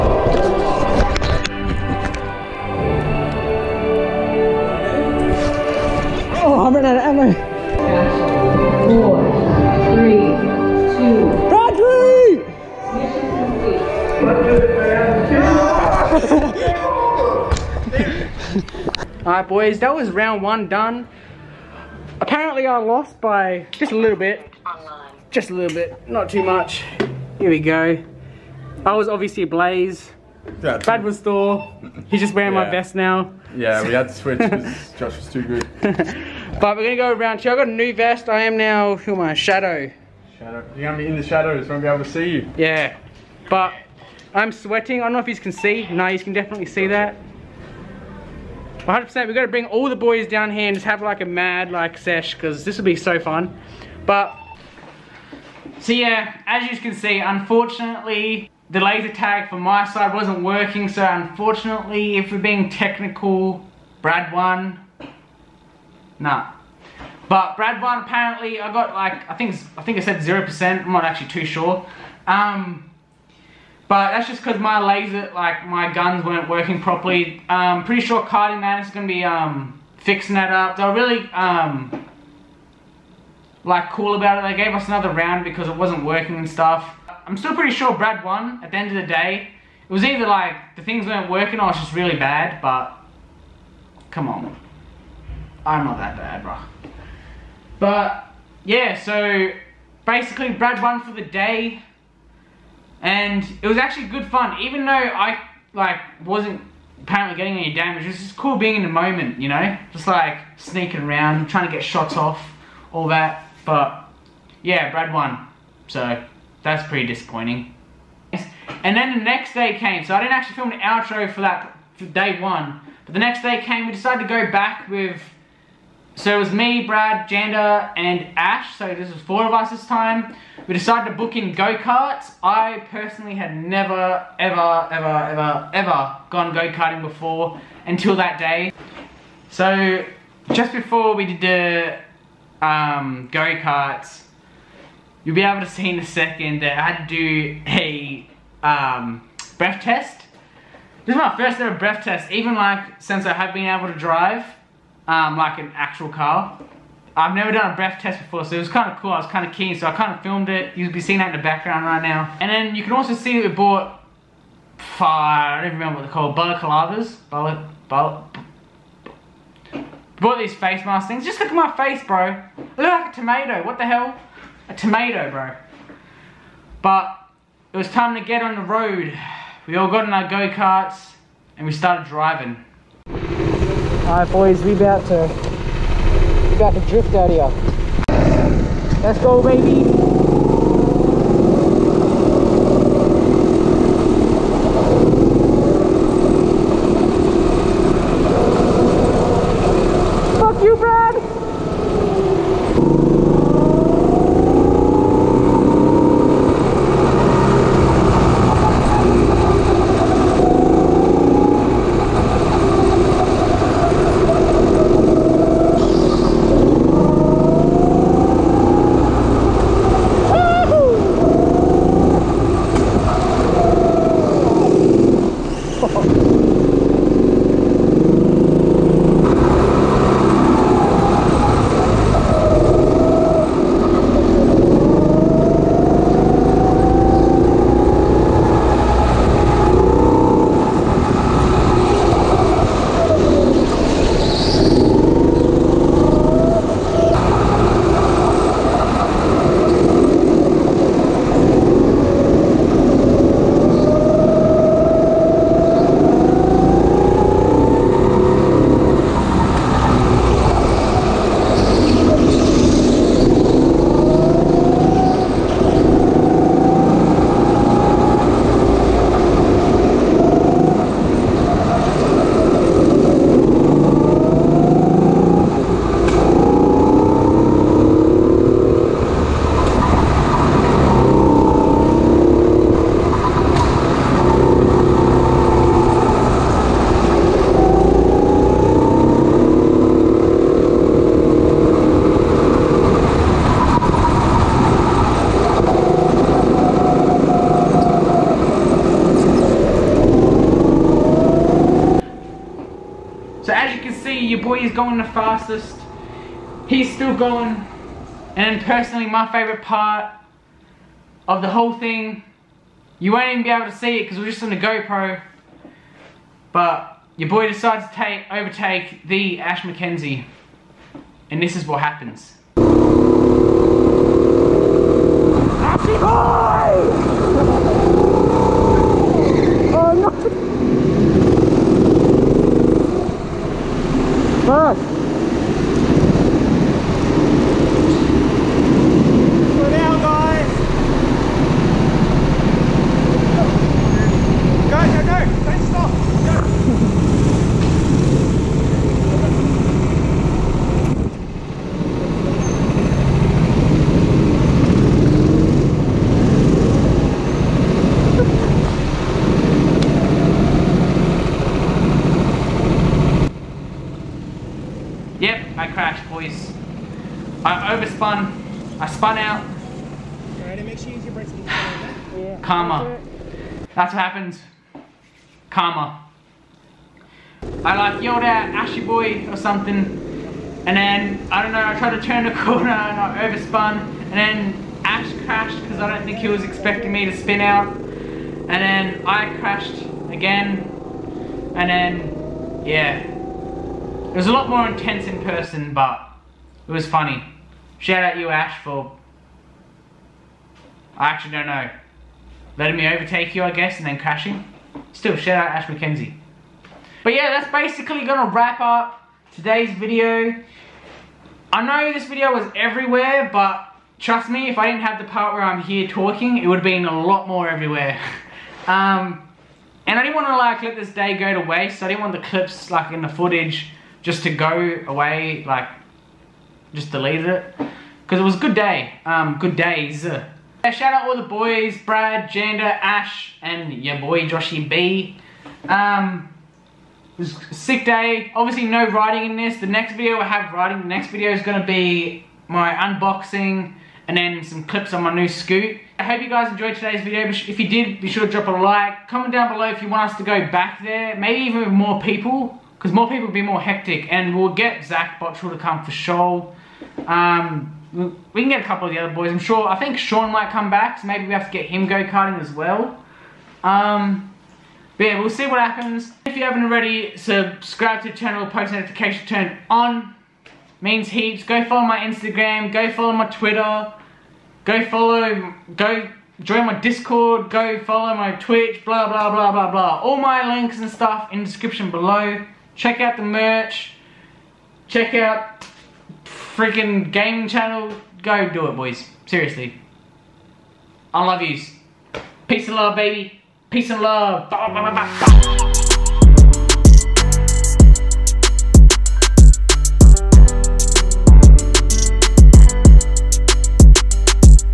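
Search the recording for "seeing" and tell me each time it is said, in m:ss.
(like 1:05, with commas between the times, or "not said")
2:40.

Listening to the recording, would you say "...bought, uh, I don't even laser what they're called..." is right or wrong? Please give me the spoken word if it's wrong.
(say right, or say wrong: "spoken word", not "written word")
wrong: "remember", not "laser".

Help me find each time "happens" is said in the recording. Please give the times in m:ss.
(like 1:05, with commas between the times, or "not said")
5:21, 6:13, 7:45.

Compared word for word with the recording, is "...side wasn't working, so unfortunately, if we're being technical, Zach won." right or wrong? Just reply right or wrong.
wrong.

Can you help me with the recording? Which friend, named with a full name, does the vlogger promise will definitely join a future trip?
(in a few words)
Zach Bottrell.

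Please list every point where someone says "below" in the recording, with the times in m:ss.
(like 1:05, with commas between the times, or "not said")
7:29, 8:01.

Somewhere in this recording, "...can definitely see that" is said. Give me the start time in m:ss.
0:46.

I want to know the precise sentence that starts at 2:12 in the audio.
I personally had never, ever, ever, ever, ever gone go-karting before until that day.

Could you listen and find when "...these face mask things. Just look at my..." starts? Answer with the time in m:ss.
2:50.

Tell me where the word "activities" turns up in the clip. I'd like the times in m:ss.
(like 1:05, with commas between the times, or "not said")
not said.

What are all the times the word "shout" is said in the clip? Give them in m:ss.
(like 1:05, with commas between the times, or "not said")
6:37, 6:45, 7:10.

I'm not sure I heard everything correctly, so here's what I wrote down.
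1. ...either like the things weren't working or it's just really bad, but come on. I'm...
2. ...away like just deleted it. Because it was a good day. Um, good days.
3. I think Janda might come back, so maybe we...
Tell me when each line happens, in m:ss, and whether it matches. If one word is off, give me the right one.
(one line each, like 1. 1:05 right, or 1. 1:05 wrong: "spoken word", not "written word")
1. 1:30 right
2. 7:04 right
3. 7:39 wrong: "Sean", not "Janda".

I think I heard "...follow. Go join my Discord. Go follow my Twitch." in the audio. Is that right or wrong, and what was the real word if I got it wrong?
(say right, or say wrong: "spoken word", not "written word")
right.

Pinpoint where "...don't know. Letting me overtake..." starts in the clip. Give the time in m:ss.
6:41.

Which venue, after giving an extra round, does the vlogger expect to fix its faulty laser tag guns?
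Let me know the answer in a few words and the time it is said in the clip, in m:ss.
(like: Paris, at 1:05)
Karting Madness, at 1:18.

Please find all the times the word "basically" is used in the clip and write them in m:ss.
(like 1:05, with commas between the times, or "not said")
1:40, 6:47.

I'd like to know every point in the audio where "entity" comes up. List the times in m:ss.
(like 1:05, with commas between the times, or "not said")
not said.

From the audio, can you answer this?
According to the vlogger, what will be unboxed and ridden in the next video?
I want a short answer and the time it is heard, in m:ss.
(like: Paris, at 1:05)
New scoot, at 7:25.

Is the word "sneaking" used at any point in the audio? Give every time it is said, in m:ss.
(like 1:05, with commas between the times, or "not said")
1:50.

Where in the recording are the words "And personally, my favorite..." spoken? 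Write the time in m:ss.
5:08.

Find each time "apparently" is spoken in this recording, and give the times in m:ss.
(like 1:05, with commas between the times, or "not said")
0:22, 1:08, 1:47.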